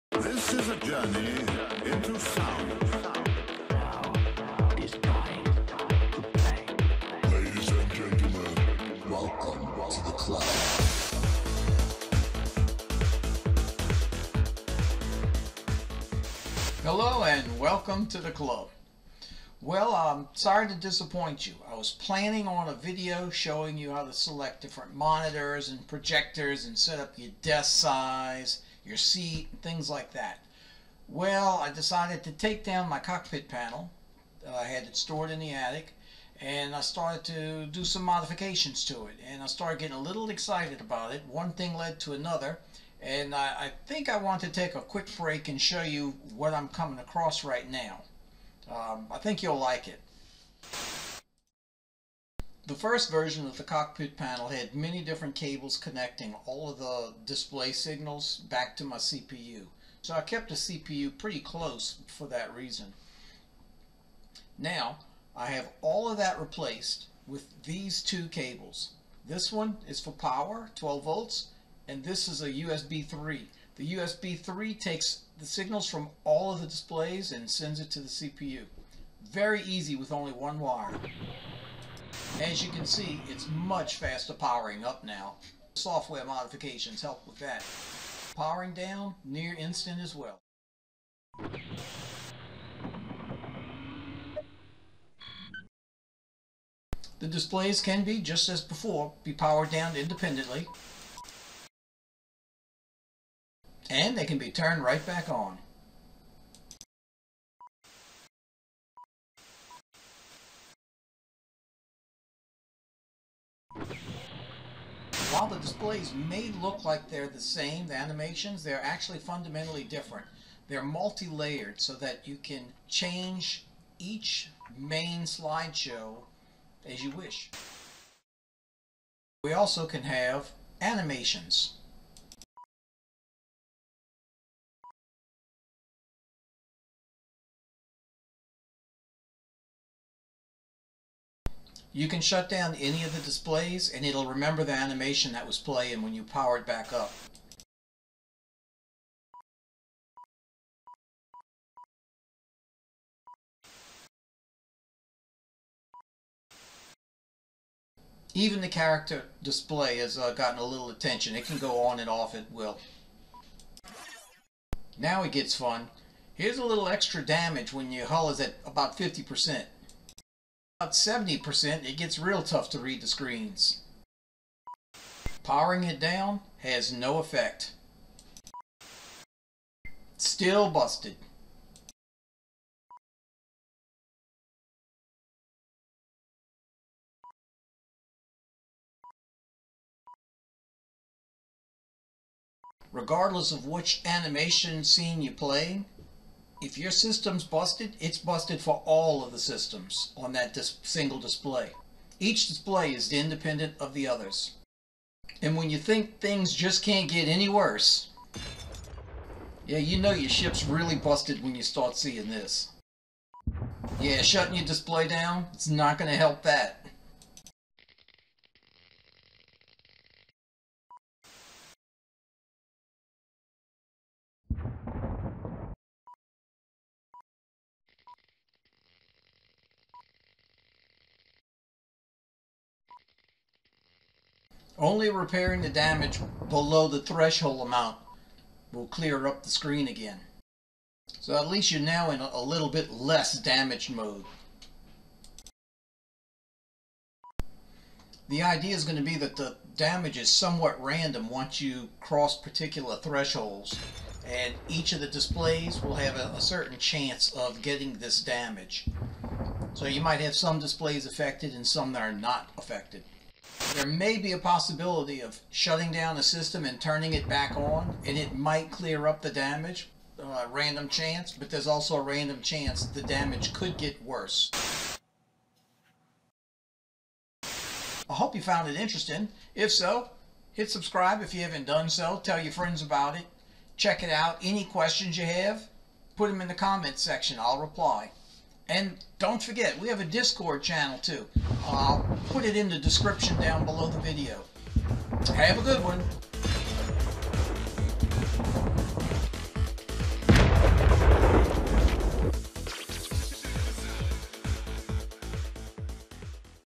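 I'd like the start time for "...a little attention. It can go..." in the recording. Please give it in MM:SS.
02:40.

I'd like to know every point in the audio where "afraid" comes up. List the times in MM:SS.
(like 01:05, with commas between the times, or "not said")
not said.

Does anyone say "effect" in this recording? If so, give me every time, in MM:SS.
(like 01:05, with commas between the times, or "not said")
02:57.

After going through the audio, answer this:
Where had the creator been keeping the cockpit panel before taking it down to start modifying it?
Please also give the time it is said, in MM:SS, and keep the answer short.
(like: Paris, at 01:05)
The attic, at 00:35.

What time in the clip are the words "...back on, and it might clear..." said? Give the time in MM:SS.
04:27.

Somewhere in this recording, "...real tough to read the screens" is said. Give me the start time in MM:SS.
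02:52.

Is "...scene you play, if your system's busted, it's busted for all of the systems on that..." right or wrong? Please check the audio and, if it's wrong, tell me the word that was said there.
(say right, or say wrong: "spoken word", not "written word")
right.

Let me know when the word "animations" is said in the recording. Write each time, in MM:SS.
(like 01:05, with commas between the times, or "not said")
01:57, 02:10, 02:24, 03:14.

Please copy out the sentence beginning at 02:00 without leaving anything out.
They're multi-layered so that you can change each main slideshow as you wish.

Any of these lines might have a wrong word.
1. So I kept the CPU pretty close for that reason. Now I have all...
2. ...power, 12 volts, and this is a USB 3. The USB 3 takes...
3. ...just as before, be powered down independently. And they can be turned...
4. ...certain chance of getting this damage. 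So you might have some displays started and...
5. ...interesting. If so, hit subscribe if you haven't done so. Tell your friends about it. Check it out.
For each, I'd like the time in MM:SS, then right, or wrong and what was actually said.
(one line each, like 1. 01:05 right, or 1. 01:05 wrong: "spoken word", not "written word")
1. 01:00 right
2. 01:10 right
3. 01:38 right
4. 04:16 wrong: "affected", not "started"
5. 04:38 right.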